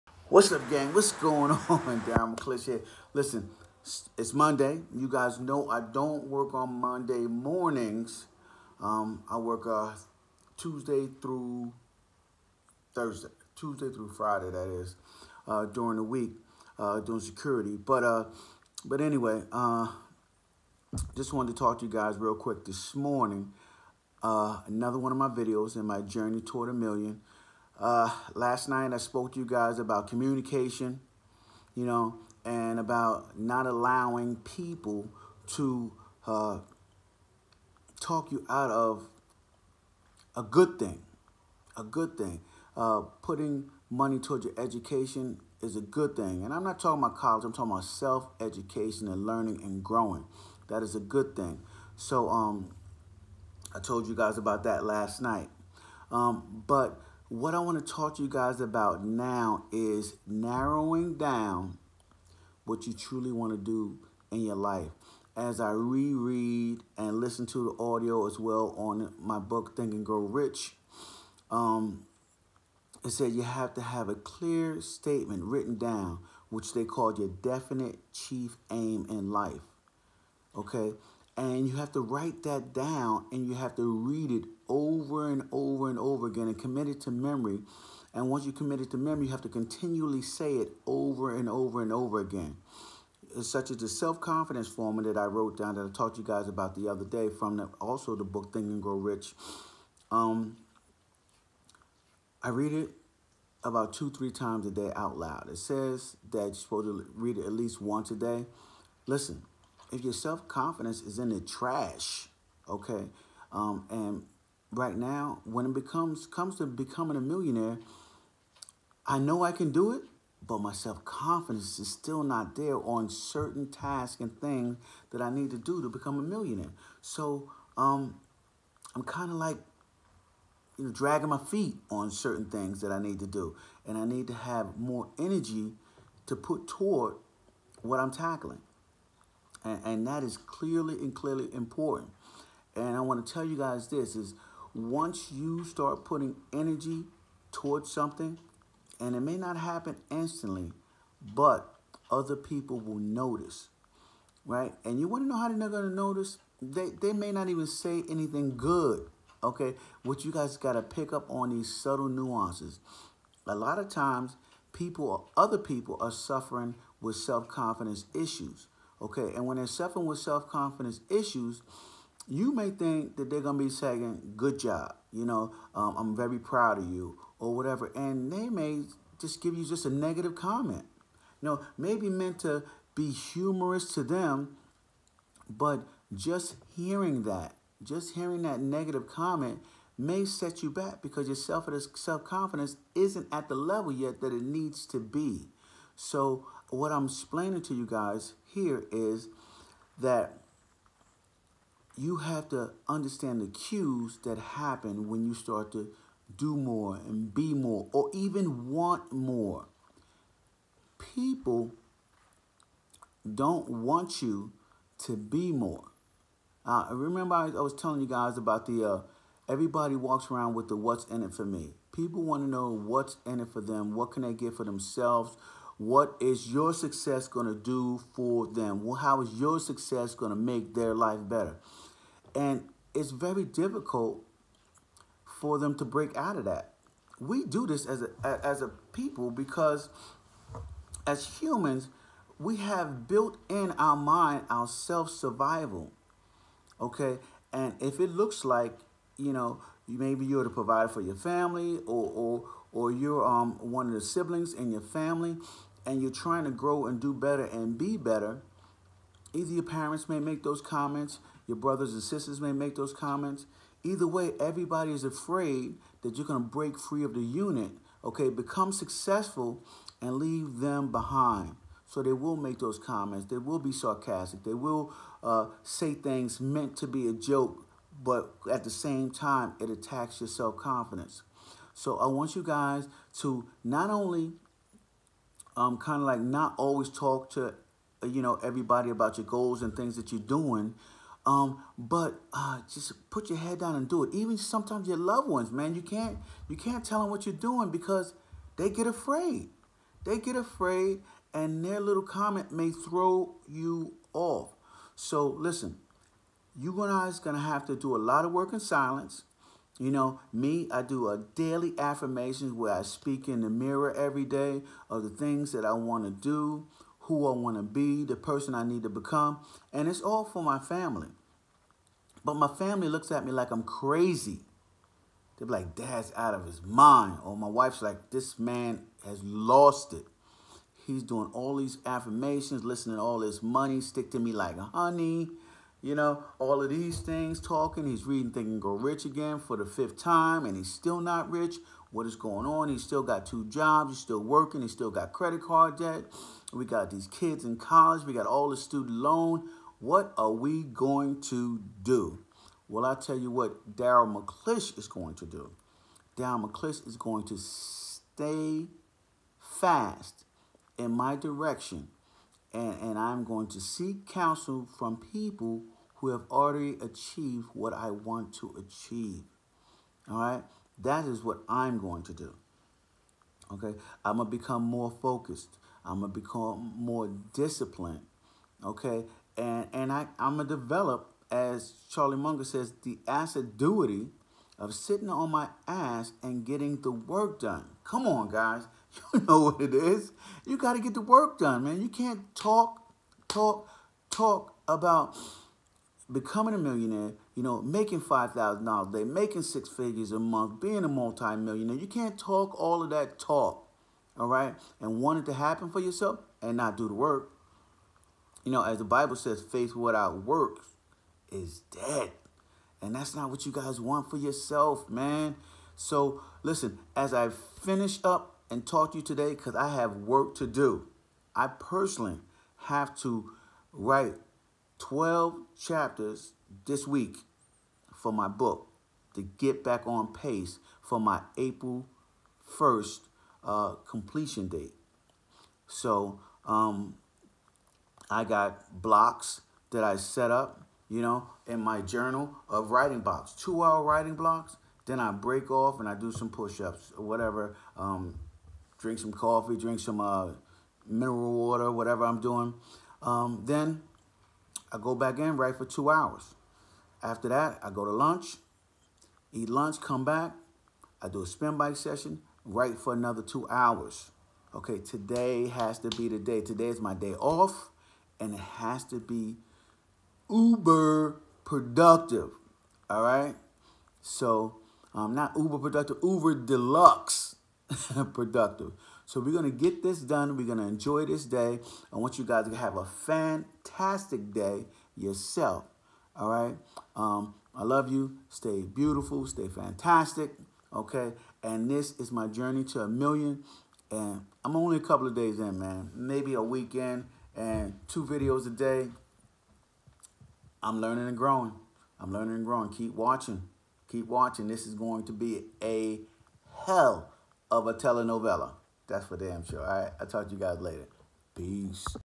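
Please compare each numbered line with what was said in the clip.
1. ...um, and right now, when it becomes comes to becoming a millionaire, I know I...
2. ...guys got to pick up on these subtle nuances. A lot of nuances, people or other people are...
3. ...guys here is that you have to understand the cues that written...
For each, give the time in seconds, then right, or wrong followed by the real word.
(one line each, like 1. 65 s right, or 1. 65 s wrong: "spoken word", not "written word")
1. 113 s right
2. 160 s wrong: "times", not "nuances"
3. 197 s wrong: "happen", not "written".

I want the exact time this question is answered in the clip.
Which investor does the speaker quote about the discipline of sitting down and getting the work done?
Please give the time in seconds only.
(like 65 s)
381 s.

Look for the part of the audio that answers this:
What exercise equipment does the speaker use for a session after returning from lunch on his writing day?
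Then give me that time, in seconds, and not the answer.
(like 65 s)
461 s.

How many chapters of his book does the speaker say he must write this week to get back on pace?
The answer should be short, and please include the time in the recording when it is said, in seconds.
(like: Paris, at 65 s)
12, at 424 s.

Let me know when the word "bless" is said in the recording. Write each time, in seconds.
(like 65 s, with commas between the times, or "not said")
not said.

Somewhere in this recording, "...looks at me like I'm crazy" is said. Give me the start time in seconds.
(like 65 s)
322 s.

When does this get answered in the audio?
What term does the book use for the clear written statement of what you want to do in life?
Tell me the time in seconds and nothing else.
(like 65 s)
77 s.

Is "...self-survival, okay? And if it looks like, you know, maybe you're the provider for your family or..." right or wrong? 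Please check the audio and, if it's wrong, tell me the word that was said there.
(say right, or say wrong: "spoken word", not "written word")
right.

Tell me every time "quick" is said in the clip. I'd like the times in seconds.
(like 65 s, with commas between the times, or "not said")
22 s.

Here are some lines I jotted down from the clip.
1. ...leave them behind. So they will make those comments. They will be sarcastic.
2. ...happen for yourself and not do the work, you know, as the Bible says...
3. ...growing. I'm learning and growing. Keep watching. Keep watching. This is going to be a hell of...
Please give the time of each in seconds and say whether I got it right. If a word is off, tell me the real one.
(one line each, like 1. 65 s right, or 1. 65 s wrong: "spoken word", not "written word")
1. 270 s right
2. 405 s right
3. 501 s right.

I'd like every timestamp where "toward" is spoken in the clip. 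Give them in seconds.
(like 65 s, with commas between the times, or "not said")
26 s, 44 s, 136 s, 147 s.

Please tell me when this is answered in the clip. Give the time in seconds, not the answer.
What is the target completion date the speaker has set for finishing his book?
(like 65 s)
431 s.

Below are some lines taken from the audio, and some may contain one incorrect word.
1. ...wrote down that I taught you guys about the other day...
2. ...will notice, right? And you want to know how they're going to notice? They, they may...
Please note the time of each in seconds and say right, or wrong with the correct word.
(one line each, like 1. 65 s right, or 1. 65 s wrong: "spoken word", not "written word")
1. 95 s right
2. 152 s right.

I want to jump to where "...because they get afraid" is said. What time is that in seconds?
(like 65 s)
297 s.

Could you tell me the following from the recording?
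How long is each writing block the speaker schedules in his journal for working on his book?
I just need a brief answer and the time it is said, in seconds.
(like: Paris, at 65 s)
2 hours, at 443 s.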